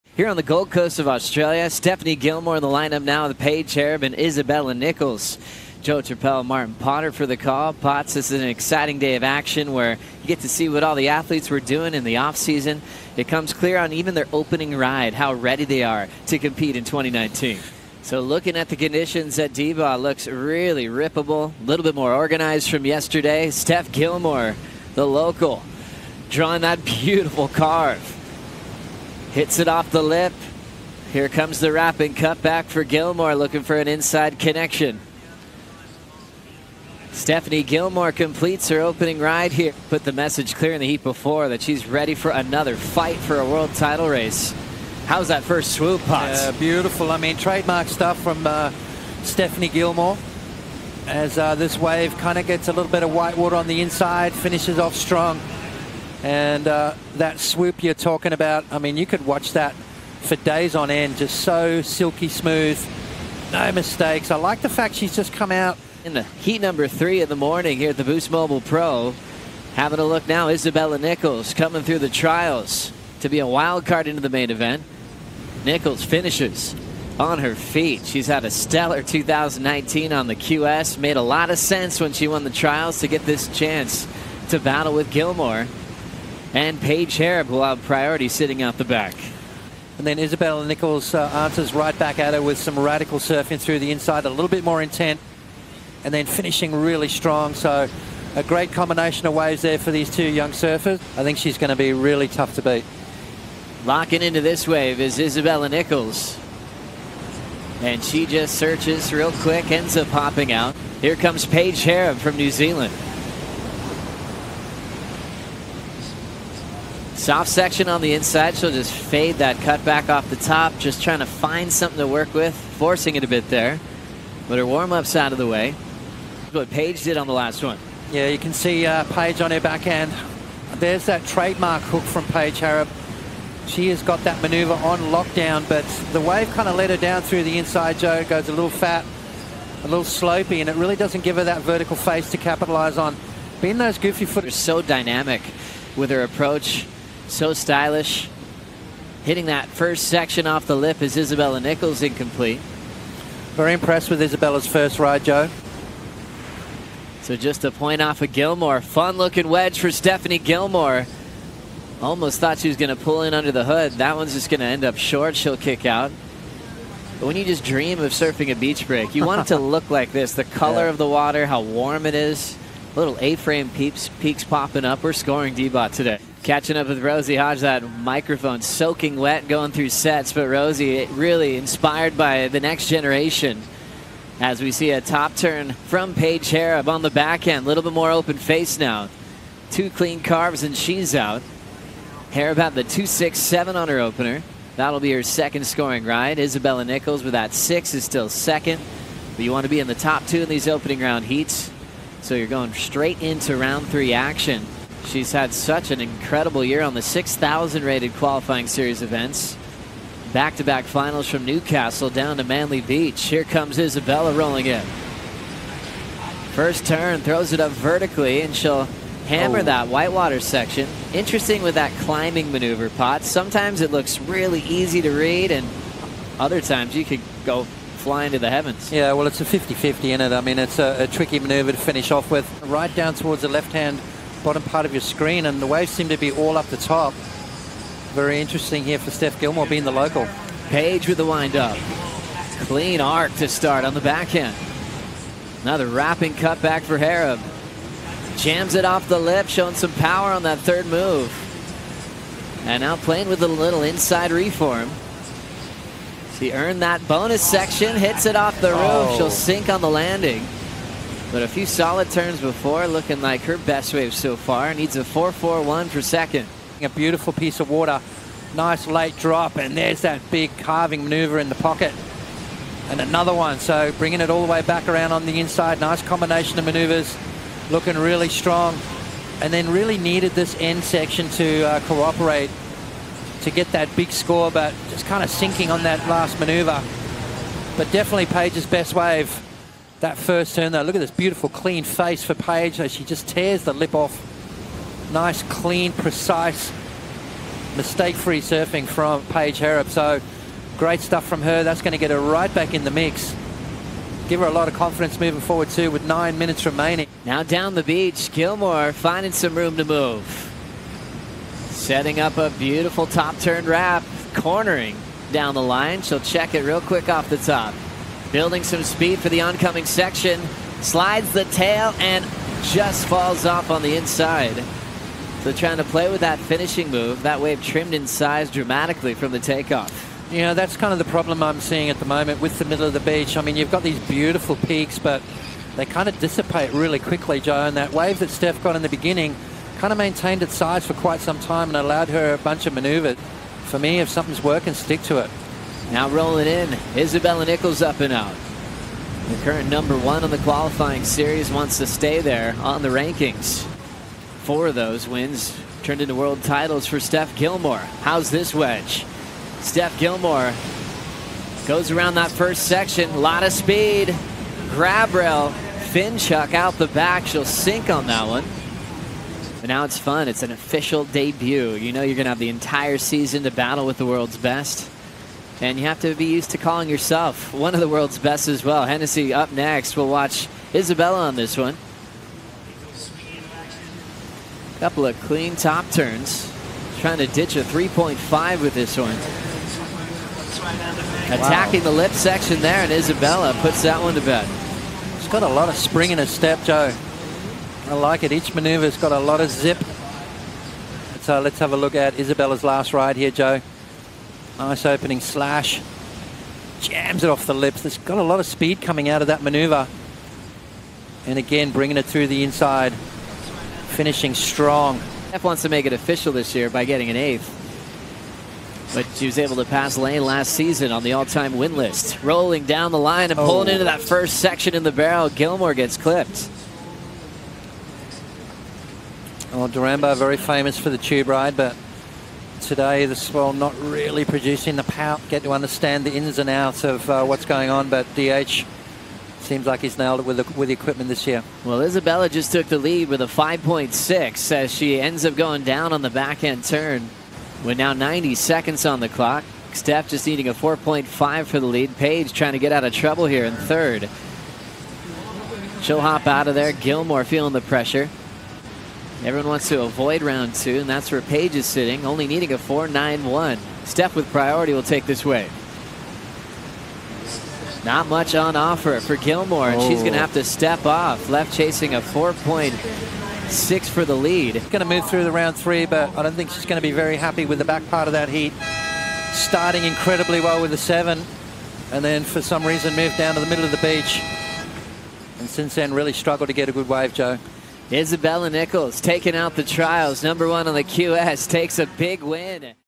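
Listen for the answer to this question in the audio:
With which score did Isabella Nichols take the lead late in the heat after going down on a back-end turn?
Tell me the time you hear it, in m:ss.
7:23.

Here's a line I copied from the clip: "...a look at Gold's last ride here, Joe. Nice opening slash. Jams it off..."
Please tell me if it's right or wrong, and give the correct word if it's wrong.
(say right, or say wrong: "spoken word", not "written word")
wrong: "Isabella", not "Gold".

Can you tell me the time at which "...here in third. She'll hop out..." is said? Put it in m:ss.
7:33.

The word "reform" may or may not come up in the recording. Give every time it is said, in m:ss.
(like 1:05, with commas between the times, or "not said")
4:14.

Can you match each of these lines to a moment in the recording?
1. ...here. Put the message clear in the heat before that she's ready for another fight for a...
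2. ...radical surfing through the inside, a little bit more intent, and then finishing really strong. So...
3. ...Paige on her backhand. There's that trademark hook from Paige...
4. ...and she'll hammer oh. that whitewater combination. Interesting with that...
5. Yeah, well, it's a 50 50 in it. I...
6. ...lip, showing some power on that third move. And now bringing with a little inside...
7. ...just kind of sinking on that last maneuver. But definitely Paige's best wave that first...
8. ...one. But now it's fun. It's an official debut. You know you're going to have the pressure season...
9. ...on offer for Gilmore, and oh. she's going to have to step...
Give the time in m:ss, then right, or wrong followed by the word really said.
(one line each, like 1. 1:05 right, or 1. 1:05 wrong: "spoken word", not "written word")
1. 0:39 right
2. 1:32 right
3. 2:09 right
4. 3:38 wrong: "section", not "combination"
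5. 3:48 right
6. 4:09 wrong: "playing", not "bringing"
7. 4:44 right
8. 6:08 wrong: "entire", not "pressure"
9. 7:48 right.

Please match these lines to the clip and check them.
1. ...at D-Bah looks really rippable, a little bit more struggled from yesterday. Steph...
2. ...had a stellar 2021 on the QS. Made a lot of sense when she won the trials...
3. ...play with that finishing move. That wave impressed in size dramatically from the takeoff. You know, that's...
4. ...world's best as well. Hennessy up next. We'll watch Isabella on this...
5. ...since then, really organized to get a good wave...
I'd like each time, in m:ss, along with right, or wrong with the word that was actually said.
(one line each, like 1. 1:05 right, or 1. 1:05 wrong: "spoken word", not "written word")
1. 0:19 wrong: "organized", not "struggled"
2. 1:18 wrong: "2019", not "2021"
3. 5:25 wrong: "trimmed", not "impressed"
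4. 6:17 right
5. 8:05 wrong: "struggled", not "organized".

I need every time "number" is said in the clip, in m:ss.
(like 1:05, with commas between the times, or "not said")
1:06, 5:49, 8:10.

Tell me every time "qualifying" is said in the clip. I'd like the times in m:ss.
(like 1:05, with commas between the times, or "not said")
3:28, 5:50.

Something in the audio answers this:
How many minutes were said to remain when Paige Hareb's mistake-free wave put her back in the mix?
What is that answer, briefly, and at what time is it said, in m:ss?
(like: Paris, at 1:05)
9, at 5:06.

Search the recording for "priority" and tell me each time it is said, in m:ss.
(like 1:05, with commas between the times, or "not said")
1:27, 7:44.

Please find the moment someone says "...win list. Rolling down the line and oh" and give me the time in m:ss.
7:01.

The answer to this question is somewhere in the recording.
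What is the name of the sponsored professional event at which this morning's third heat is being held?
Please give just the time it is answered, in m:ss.
1:08.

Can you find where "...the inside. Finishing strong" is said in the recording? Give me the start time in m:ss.
6:52.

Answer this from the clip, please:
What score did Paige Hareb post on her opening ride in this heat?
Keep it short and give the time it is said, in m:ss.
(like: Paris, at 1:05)
2.67, at 3:12.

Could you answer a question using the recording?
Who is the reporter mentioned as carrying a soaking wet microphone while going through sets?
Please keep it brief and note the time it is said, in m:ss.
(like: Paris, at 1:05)
Rosie Hodge, at 2:57.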